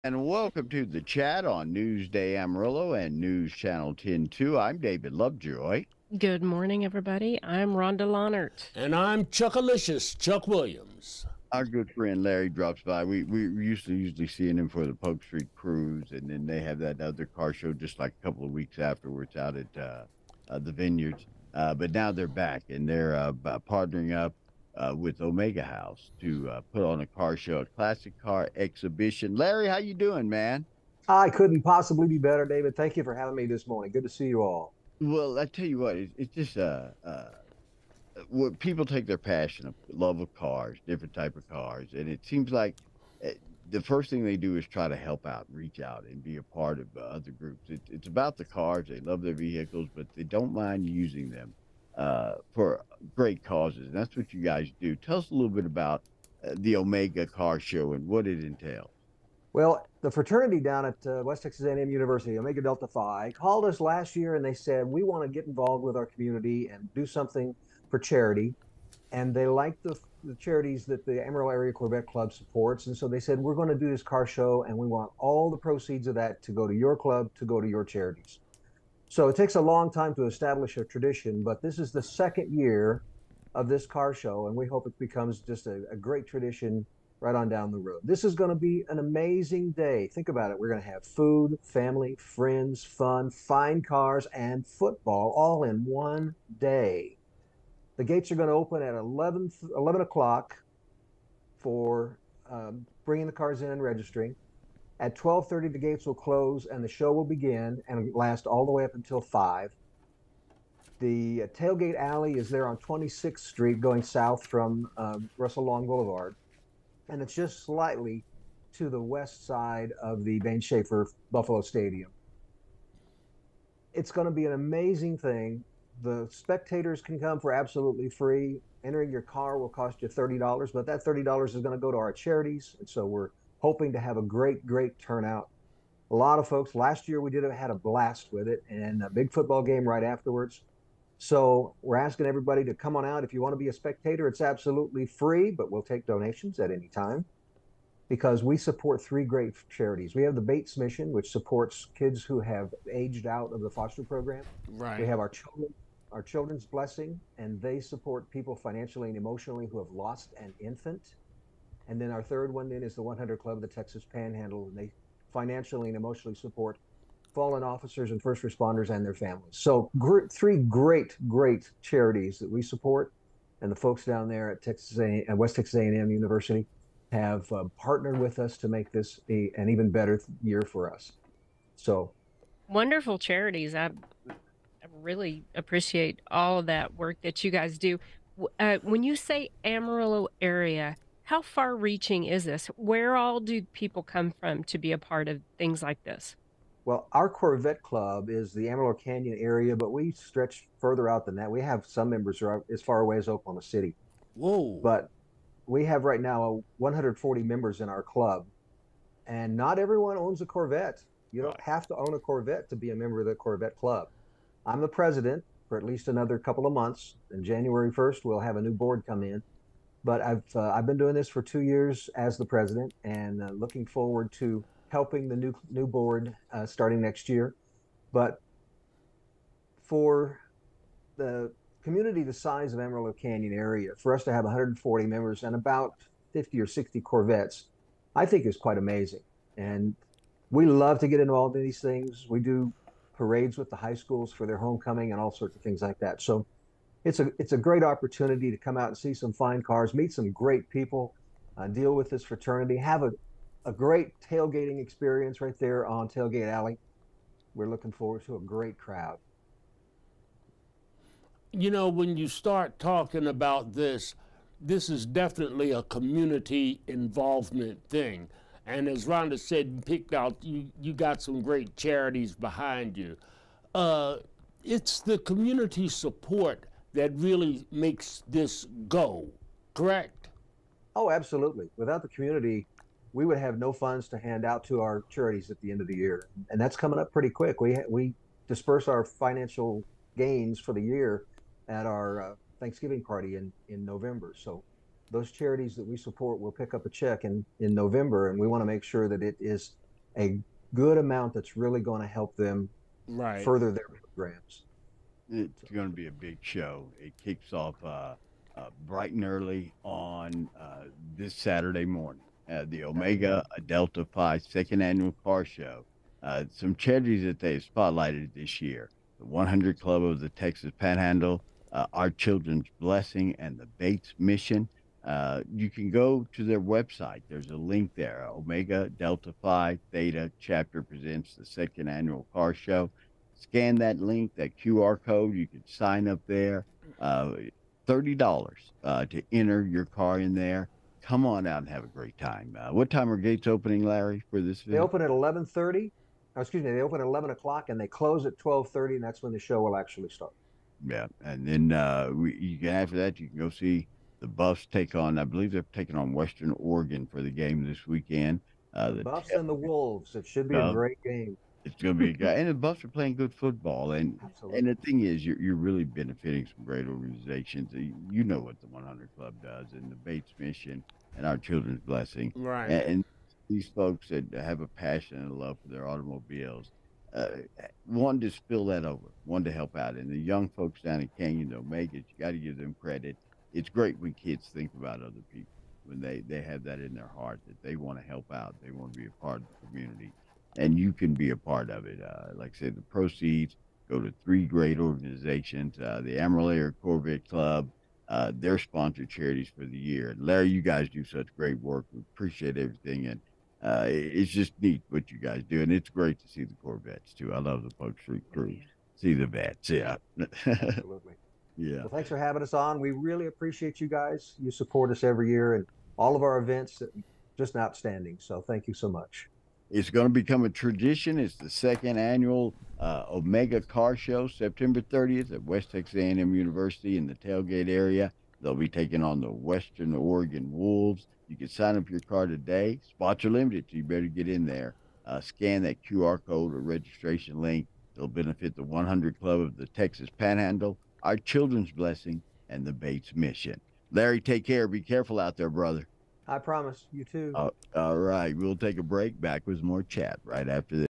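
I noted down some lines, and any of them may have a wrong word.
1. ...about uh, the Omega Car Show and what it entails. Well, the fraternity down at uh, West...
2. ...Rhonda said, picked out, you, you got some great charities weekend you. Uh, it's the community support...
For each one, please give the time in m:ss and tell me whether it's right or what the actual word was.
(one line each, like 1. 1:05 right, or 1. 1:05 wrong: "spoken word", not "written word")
1. 0:55 right
2. 4:29 wrong: "behind", not "weekend".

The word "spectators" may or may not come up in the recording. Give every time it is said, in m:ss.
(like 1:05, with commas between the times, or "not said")
2:06, 2:23.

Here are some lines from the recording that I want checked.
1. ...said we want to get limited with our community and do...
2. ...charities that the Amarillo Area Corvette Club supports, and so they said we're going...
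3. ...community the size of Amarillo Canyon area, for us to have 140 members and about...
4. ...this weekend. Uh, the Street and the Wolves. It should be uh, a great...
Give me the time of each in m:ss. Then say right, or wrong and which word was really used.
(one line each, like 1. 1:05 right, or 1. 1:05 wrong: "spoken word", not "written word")
1. 1:04 wrong: "involved", not "limited"
2. 1:10 right
3. 3:51 right
4. 5:57 wrong: "Buffs", not "Street".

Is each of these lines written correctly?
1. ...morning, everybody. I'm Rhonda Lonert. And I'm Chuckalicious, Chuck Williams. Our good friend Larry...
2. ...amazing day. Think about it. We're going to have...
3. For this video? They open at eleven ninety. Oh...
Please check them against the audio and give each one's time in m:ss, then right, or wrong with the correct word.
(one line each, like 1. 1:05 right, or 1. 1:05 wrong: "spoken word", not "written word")
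1. 0:06 right
2. 1:28 right
3. 5:44 wrong: "thirty", not "ninety".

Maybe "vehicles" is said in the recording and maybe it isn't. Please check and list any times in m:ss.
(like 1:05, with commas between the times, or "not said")
0:49.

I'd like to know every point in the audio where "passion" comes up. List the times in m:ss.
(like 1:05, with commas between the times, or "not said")
0:39, 6:14.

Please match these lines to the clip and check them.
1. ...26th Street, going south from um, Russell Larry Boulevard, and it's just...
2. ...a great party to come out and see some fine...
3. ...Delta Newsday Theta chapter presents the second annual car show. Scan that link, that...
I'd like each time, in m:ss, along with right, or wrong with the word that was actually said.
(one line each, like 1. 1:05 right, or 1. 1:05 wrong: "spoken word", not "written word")
1. 1:52 wrong: "Long", not "Larry"
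2. 4:07 wrong: "opportunity", not "party"
3. 5:28 wrong: "Phi", not "Newsday".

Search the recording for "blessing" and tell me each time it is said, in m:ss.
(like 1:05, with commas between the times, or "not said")
2:36, 5:22, 6:11, 7:21.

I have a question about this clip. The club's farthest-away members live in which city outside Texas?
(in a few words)
Oklahoma City.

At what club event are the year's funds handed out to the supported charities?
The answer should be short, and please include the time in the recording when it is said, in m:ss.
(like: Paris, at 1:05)
Thanksgiving party, at 4:52.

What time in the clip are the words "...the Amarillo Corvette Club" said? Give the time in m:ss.
6:36.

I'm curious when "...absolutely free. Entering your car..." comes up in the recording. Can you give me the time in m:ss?
2:07.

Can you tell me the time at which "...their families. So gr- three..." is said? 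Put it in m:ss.
2:49.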